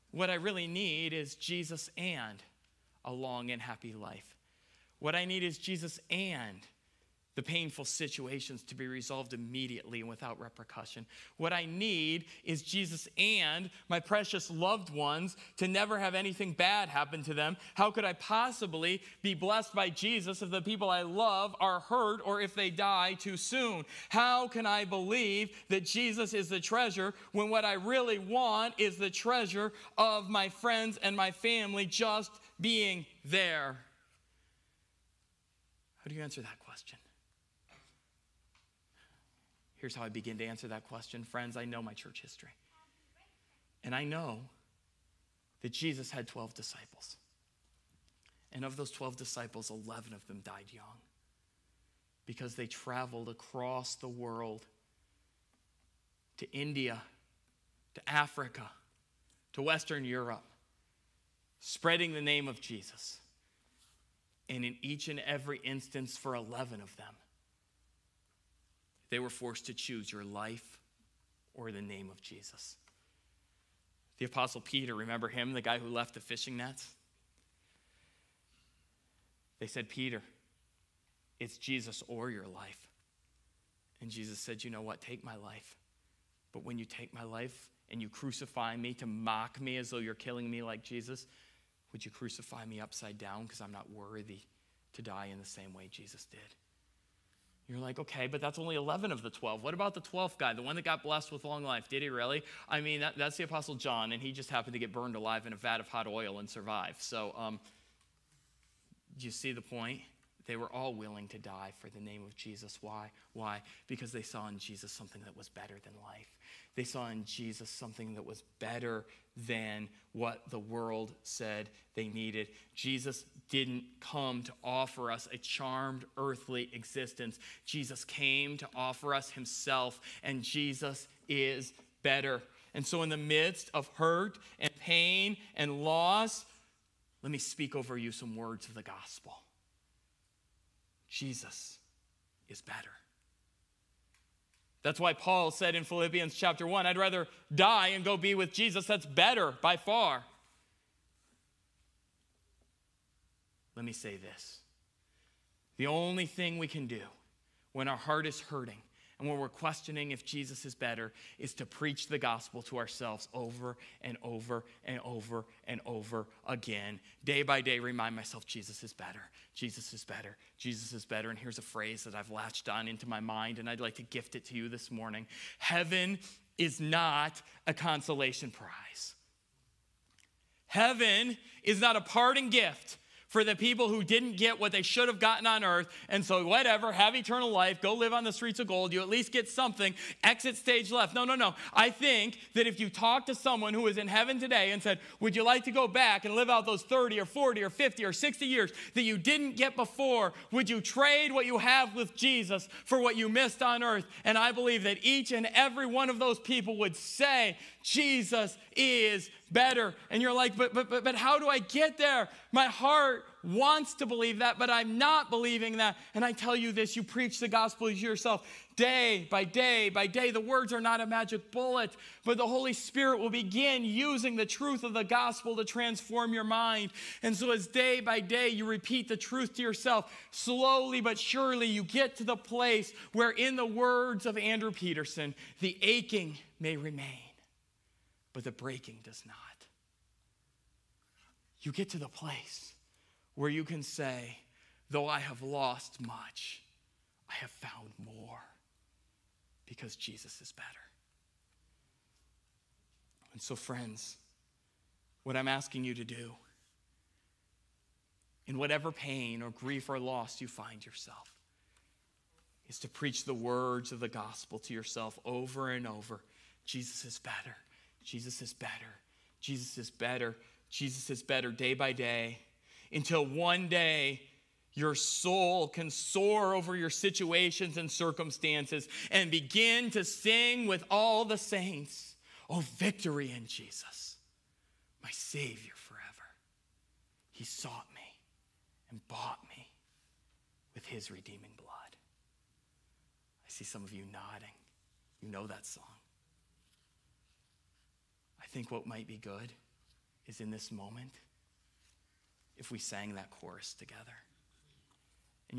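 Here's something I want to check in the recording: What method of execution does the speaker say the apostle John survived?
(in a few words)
Vat of hot oil.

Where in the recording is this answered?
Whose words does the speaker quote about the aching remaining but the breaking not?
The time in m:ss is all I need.
3:54.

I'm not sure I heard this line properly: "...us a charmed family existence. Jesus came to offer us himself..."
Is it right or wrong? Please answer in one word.
wrong.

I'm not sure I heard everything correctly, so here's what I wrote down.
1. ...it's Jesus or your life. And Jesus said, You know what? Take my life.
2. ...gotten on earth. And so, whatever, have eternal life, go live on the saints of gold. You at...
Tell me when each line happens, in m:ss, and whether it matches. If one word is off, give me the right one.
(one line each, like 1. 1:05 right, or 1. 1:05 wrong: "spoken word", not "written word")
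1. 1:21 right
2. 3:05 wrong: "streets", not "saints".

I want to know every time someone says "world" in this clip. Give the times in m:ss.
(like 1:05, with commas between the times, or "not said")
0:54, 2:00.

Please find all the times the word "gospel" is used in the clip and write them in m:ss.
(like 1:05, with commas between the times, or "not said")
2:18, 2:42, 3:37, 3:45, 4:24.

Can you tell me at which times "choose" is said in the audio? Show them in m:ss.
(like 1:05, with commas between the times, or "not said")
1:09.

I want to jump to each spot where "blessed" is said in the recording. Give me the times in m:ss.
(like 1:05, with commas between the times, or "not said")
0:19, 1:41.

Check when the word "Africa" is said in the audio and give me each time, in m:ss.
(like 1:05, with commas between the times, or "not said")
0:58.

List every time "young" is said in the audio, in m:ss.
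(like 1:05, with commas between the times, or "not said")
0:50.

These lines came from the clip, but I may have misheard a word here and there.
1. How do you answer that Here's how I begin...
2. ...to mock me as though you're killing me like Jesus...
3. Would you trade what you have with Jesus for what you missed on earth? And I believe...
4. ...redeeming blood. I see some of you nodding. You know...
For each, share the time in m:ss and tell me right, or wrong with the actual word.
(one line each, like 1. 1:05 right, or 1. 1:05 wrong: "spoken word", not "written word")
1. 0:36 right
2. 1:28 right
3. 3:20 right
4. 4:51 right.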